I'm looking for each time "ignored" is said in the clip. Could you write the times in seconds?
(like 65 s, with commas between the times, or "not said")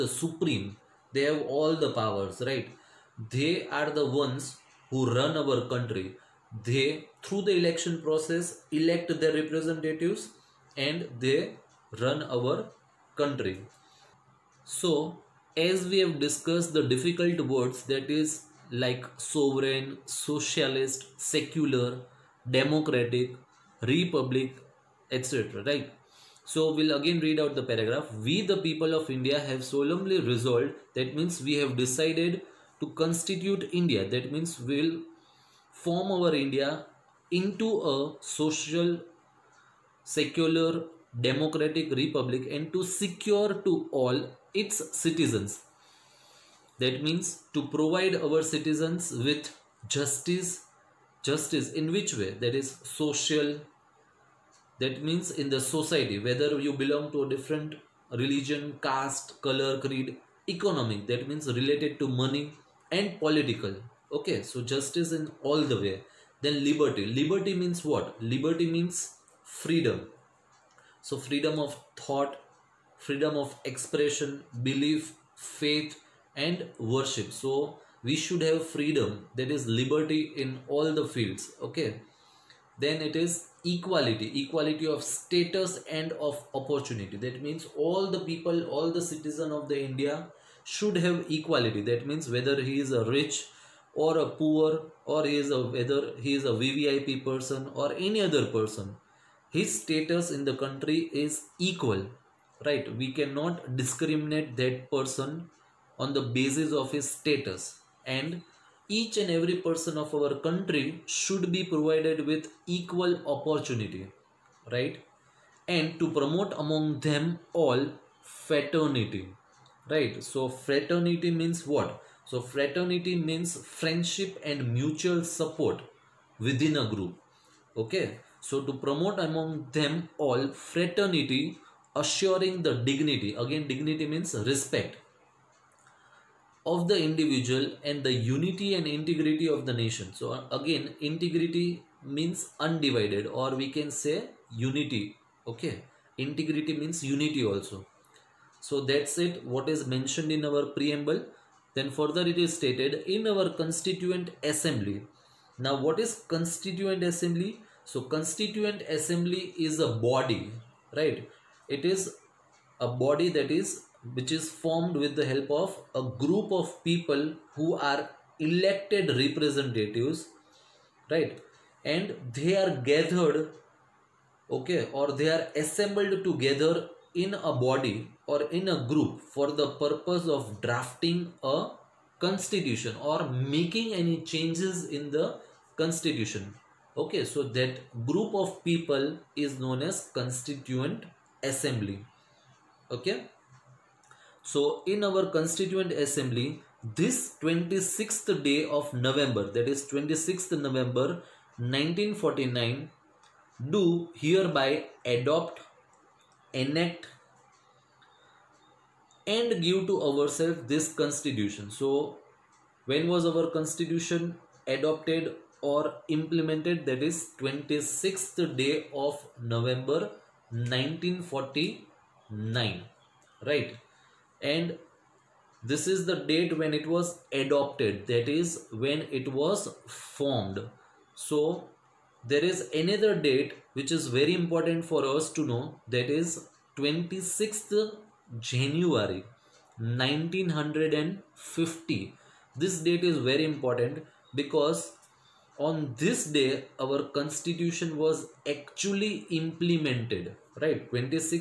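not said.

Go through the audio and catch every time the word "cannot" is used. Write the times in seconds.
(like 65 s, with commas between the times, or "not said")
103 s.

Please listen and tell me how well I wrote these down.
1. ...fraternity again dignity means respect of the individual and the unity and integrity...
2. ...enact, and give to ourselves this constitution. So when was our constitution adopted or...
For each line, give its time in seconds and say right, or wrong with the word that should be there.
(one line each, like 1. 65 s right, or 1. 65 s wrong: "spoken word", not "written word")
1. 132 s wrong: "dignity", not "fraternity"
2. 206 s right.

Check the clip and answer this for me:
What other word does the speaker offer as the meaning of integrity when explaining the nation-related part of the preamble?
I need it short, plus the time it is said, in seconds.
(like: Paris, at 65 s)
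Undivided, at 142 s.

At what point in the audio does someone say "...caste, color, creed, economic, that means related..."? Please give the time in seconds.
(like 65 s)
58 s.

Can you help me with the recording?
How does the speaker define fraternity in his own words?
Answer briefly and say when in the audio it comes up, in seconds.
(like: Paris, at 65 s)
Friendship and mutual support, at 123 s.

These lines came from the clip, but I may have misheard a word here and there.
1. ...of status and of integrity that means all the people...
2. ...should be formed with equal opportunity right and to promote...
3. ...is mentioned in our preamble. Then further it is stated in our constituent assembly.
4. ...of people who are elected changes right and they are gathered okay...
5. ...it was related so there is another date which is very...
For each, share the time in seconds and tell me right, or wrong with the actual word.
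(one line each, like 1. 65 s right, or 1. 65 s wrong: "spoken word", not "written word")
1. 84 s wrong: "opportunity", not "integrity"
2. 111 s wrong: "provided", not "formed"
3. 149 s right
4. 166 s wrong: "representatives", not "changes"
5. 229 s wrong: "formed", not "related".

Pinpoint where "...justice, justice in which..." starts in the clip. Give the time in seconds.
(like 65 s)
49 s.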